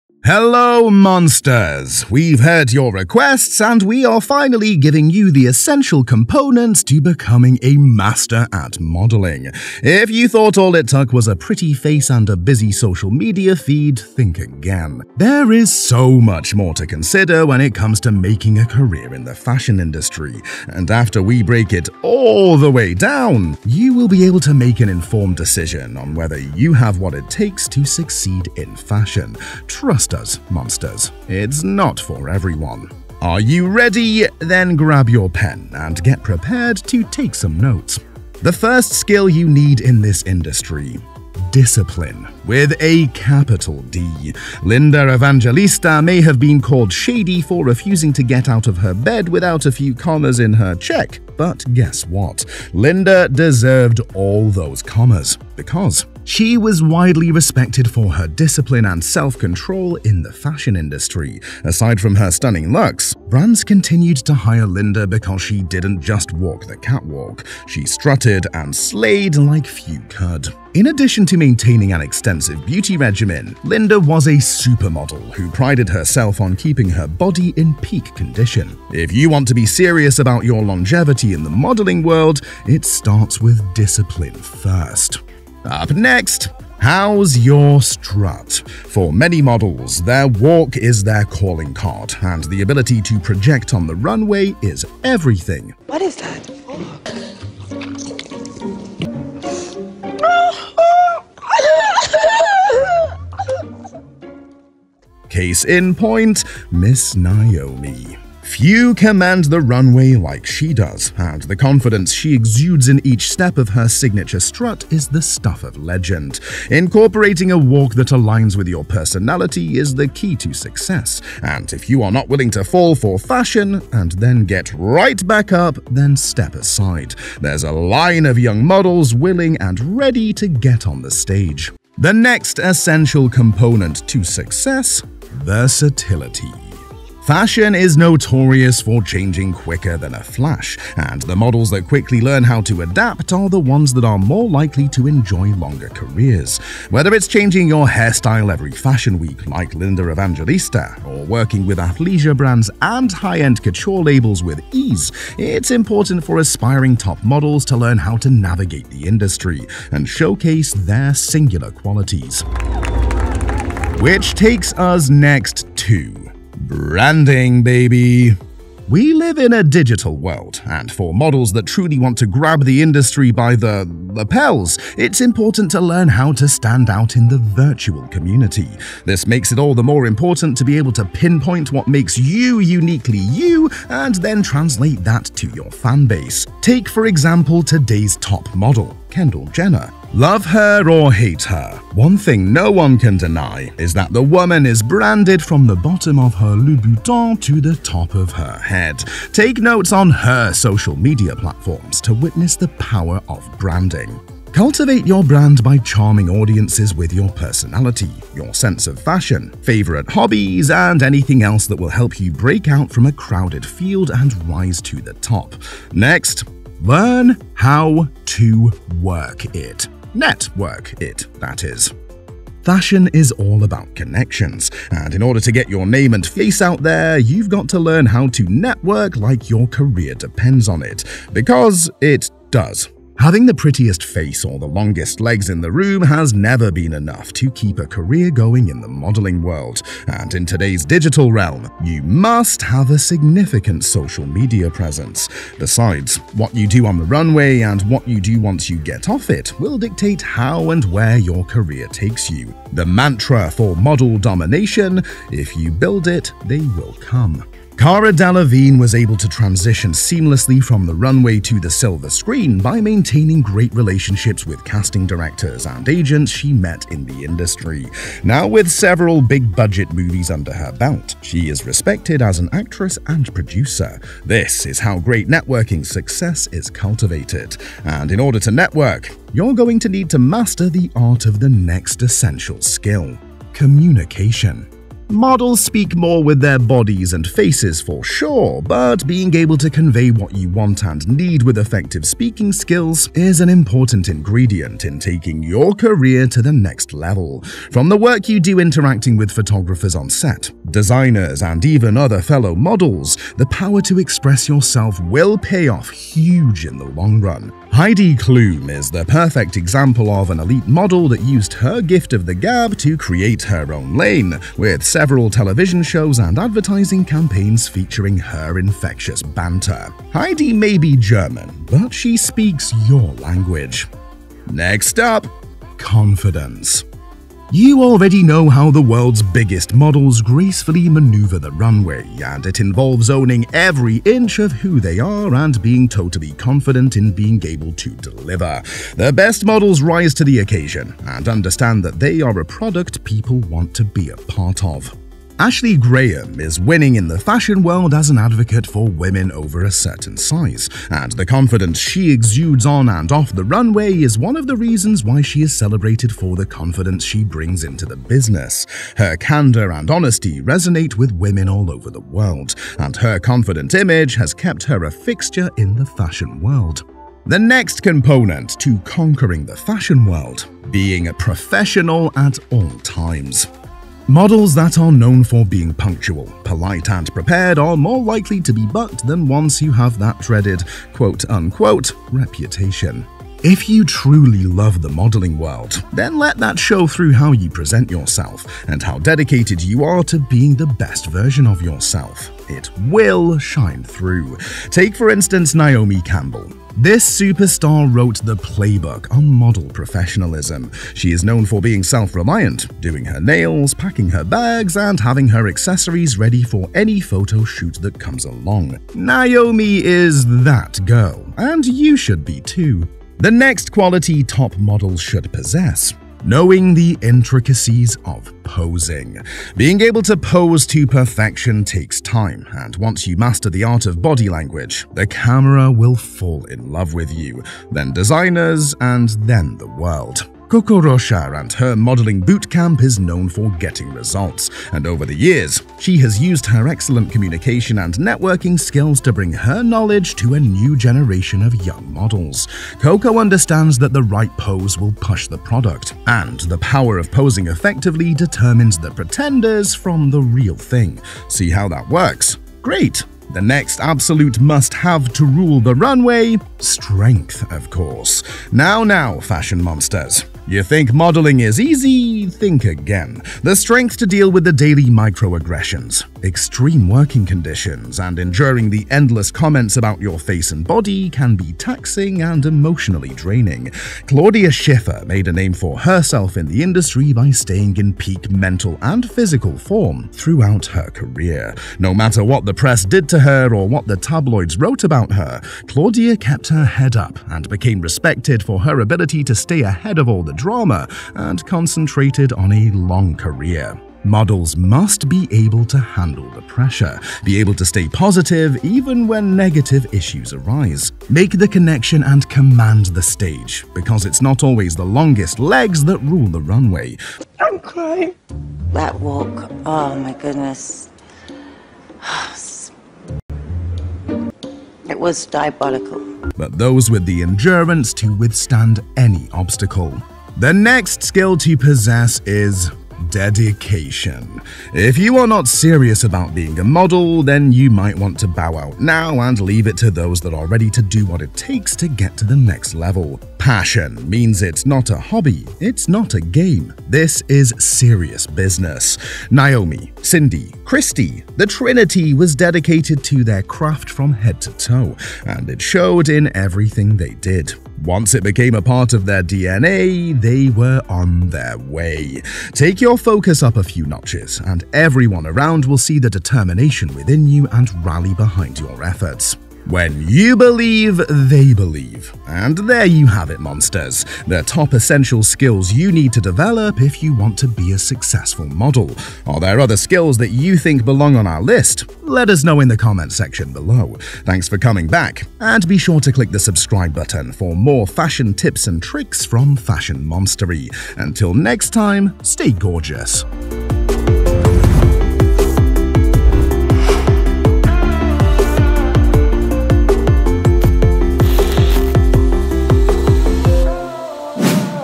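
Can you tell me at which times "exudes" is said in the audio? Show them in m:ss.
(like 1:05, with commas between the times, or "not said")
1:52, 5:52.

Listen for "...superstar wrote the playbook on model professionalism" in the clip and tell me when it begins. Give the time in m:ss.
6:37.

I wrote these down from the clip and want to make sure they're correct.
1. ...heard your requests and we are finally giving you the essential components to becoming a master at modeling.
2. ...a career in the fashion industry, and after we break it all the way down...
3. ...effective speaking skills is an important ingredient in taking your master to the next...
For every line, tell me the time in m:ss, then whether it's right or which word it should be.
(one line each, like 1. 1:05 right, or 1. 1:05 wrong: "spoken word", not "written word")
1. 0:02 right
2. 0:18 right
3. 4:51 wrong: "career", not "master".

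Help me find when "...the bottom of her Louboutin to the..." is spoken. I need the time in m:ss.
3:15.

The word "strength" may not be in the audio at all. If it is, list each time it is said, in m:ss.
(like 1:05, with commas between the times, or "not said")
7:36, 7:43.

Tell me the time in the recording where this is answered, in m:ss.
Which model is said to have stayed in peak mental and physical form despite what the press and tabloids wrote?
7:54.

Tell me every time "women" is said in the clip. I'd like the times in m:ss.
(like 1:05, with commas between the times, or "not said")
5:48, 6:01.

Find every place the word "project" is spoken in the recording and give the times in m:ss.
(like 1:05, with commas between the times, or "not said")
1:33.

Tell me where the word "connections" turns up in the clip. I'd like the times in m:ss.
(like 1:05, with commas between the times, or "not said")
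3:43, 8:21.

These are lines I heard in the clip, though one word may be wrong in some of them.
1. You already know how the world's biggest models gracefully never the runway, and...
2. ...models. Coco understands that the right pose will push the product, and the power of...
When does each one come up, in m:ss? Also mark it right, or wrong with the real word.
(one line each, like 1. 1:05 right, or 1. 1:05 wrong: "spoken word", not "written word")
1. 5:27 wrong: "maneuver", not "never"
2. 7:21 right.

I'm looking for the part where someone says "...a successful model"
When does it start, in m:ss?
9:27.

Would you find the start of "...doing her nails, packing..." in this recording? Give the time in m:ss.
6:42.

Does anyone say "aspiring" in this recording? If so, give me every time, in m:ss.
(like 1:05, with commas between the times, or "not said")
2:36.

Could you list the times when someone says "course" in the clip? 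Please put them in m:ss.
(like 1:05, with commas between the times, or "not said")
7:37.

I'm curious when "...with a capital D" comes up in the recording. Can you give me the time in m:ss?
0:42.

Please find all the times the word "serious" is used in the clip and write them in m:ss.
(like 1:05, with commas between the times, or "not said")
1:19, 8:45, 8:57.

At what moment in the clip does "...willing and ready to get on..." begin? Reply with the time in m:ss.
2:09.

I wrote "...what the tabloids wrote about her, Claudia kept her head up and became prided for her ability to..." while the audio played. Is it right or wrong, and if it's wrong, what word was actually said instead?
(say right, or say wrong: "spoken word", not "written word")
wrong: "respected", not "prided".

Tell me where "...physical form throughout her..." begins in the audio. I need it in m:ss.
7:59.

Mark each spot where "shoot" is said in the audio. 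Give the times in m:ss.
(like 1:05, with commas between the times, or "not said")
6:47.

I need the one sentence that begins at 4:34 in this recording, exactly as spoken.
This is how great networking success is cultivated.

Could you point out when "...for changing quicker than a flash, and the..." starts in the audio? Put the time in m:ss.
2:18.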